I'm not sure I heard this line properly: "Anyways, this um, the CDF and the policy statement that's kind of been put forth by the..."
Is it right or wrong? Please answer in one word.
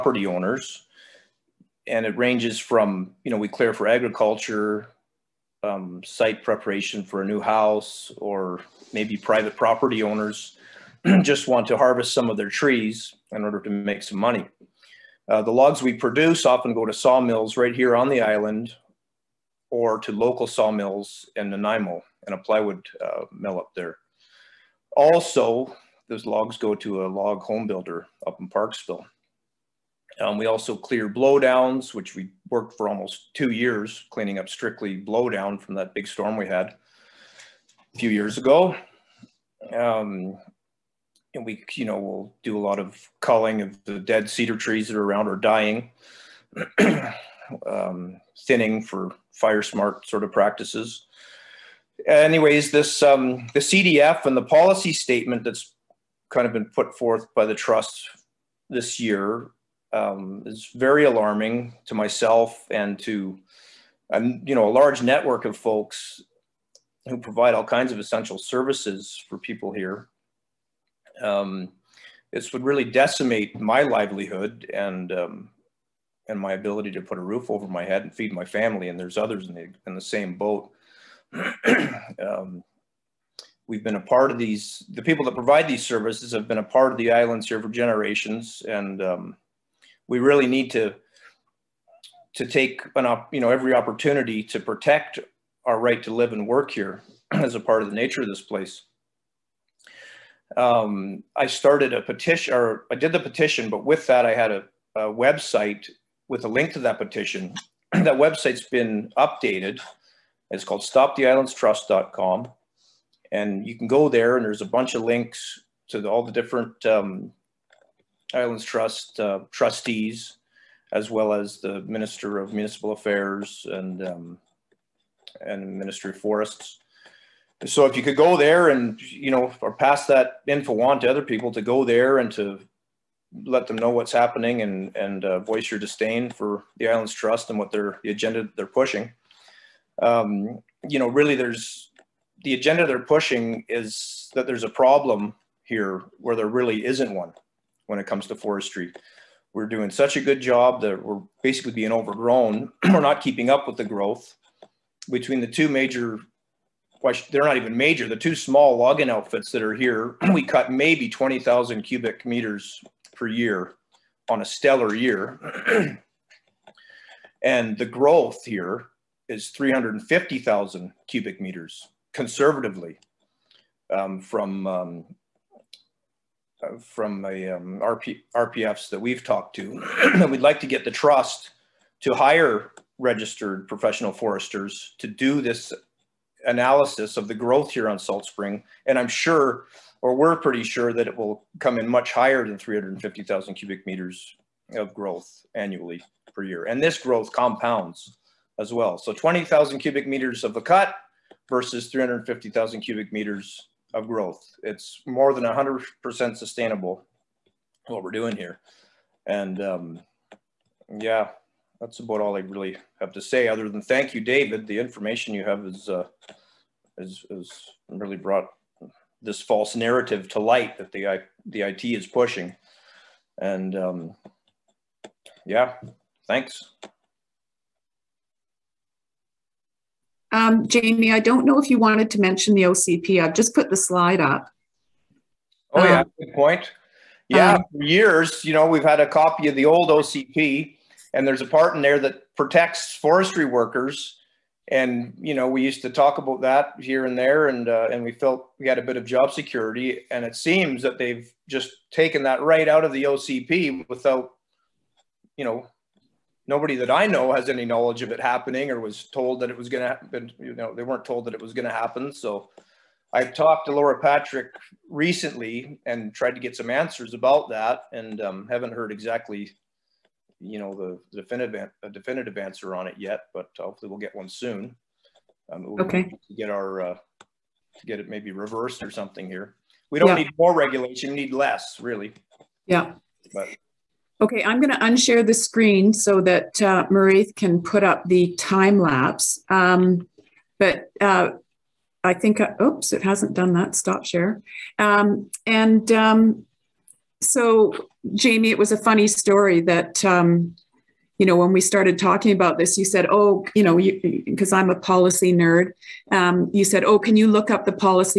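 right.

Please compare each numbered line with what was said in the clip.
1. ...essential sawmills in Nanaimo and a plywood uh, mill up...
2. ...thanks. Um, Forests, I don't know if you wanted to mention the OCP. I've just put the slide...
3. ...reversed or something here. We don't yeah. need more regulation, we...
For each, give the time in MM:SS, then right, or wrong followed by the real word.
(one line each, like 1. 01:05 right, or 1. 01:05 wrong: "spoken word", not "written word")
1. 00:20 wrong: "local", not "essential"
2. 03:46 wrong: "Jamie", not "Forests"
3. 04:38 right.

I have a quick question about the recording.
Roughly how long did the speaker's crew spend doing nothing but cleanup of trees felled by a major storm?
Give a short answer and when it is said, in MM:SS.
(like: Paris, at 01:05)
almost two years, at 00:32.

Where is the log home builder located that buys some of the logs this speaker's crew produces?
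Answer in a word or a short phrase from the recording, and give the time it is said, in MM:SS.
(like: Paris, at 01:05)
Parksville, at 00:28.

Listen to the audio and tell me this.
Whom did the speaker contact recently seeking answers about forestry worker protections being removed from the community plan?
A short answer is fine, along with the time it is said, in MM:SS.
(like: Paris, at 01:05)
Laura Patrick, at 04:23.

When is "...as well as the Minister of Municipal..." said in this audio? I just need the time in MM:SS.
02:00.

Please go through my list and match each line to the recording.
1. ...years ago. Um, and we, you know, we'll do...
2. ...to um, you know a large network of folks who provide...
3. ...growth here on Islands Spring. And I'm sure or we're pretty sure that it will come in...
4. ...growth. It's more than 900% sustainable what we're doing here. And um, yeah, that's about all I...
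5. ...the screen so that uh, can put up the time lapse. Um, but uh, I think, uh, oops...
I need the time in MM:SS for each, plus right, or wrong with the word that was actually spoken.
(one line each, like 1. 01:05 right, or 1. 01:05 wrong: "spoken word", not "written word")
1. 00:38 right
2. 01:03 right
3. 03:07 wrong: "Salt", not "Islands"
4. 03:24 wrong: "100", not "900"
5. 04:45 right.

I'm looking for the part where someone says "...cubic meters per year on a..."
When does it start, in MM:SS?
02:41.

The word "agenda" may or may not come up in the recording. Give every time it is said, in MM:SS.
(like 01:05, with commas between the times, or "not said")
02:18, 02:22.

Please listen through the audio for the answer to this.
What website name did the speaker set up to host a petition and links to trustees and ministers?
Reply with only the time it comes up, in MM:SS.
01:50.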